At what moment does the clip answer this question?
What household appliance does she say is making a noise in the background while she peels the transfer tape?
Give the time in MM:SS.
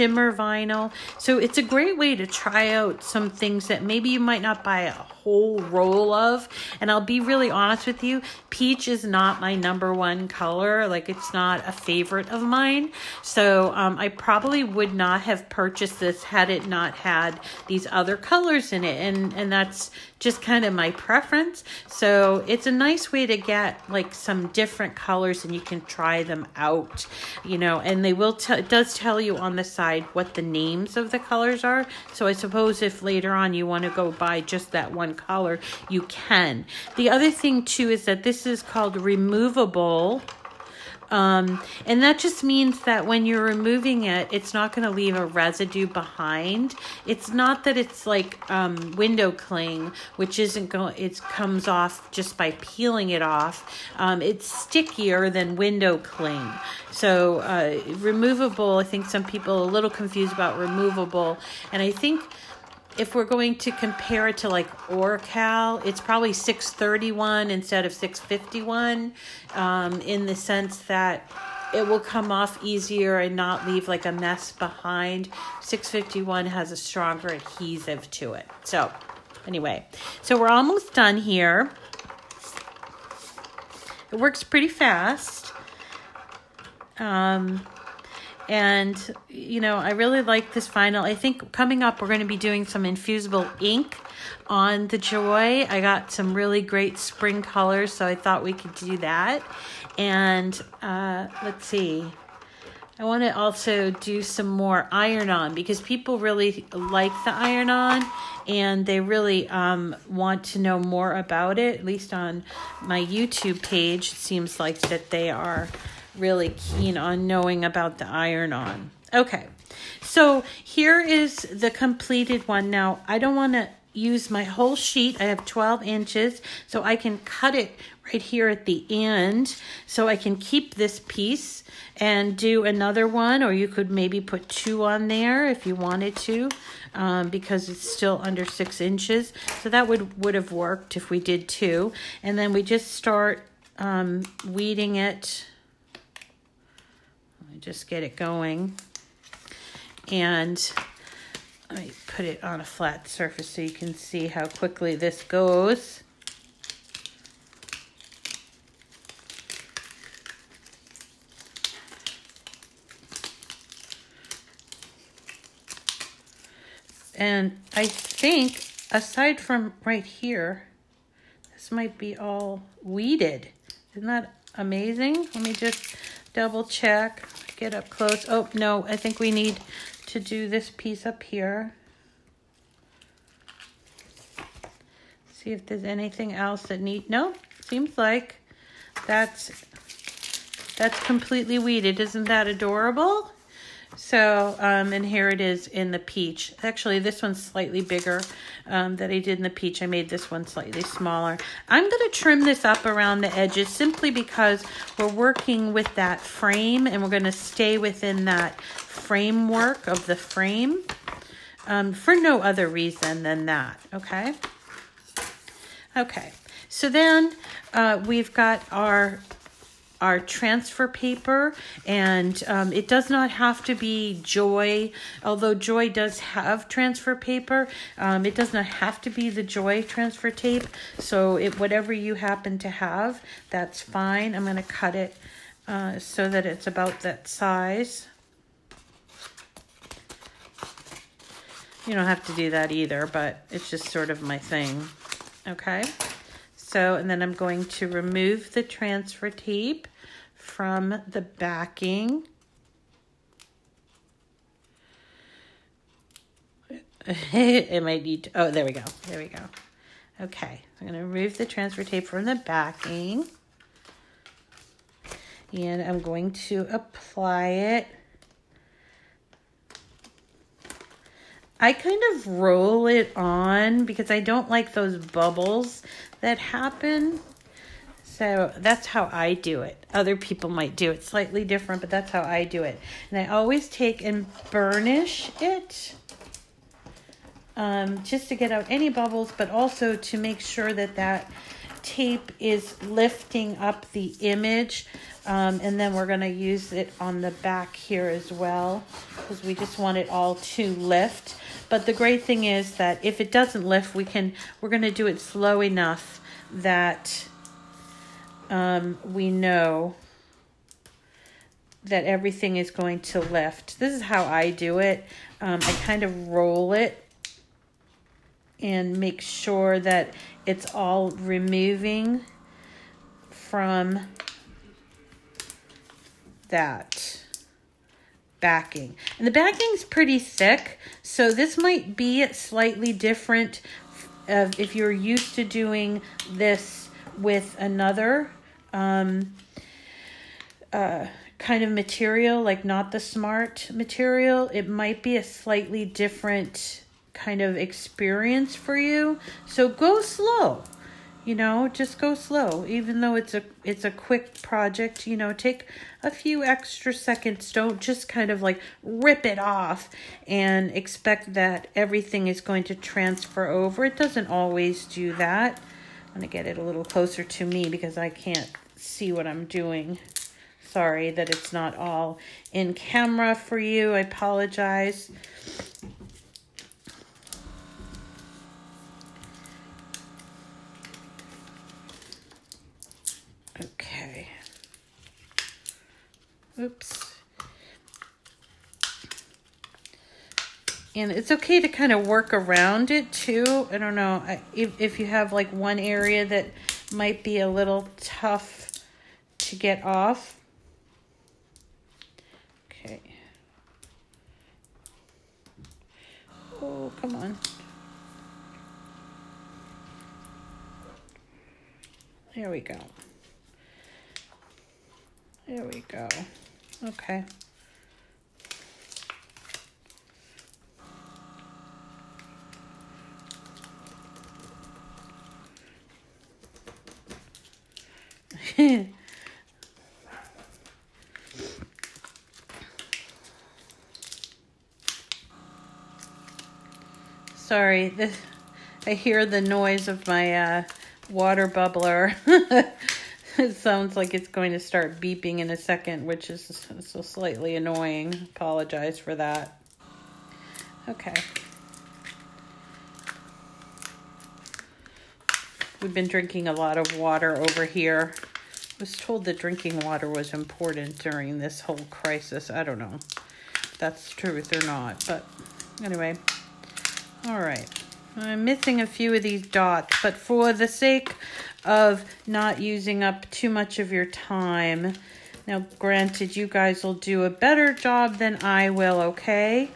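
07:21.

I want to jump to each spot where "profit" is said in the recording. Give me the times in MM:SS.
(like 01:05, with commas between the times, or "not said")
not said.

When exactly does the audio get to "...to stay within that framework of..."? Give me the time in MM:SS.
03:27.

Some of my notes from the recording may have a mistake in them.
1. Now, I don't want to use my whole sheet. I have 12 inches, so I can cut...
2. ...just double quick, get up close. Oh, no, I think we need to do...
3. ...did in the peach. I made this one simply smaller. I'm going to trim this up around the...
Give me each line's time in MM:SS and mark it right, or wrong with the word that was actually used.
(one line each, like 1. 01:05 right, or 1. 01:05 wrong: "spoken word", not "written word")
1. 02:02 right
2. 02:55 wrong: "check", not "quick"
3. 03:19 wrong: "slightly", not "simply".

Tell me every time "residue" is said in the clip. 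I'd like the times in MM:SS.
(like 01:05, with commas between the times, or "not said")
00:45.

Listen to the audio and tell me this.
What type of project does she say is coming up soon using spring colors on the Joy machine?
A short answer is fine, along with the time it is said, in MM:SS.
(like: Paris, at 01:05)
Infusible ink, at 01:32.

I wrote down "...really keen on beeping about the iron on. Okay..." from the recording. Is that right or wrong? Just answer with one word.
wrong.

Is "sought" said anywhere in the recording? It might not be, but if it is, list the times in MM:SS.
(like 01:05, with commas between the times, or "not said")
not said.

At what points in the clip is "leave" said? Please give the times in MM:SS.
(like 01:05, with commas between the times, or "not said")
00:44, 01:13.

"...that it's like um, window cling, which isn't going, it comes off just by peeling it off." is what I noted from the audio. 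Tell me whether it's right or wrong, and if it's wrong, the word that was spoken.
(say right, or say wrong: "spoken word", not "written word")
right.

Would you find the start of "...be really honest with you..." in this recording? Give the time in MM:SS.
00:06.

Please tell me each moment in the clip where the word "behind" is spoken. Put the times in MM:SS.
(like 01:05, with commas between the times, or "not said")
00:45, 01:14.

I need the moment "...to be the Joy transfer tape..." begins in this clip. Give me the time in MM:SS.
03:49.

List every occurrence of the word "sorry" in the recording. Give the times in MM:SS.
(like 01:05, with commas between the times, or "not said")
06:10, 07:17.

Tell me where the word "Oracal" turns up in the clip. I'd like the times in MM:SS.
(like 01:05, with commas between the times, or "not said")
01:04.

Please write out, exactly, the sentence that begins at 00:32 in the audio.
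So I suppose if later on you want to go buy just that one color, you can.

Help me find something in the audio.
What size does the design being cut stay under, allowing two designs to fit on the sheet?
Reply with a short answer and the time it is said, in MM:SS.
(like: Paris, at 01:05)
6 inches, at 02:18.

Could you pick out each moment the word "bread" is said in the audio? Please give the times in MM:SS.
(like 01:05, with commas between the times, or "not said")
not said.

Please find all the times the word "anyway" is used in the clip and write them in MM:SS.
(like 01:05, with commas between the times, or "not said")
01:19, 07:45.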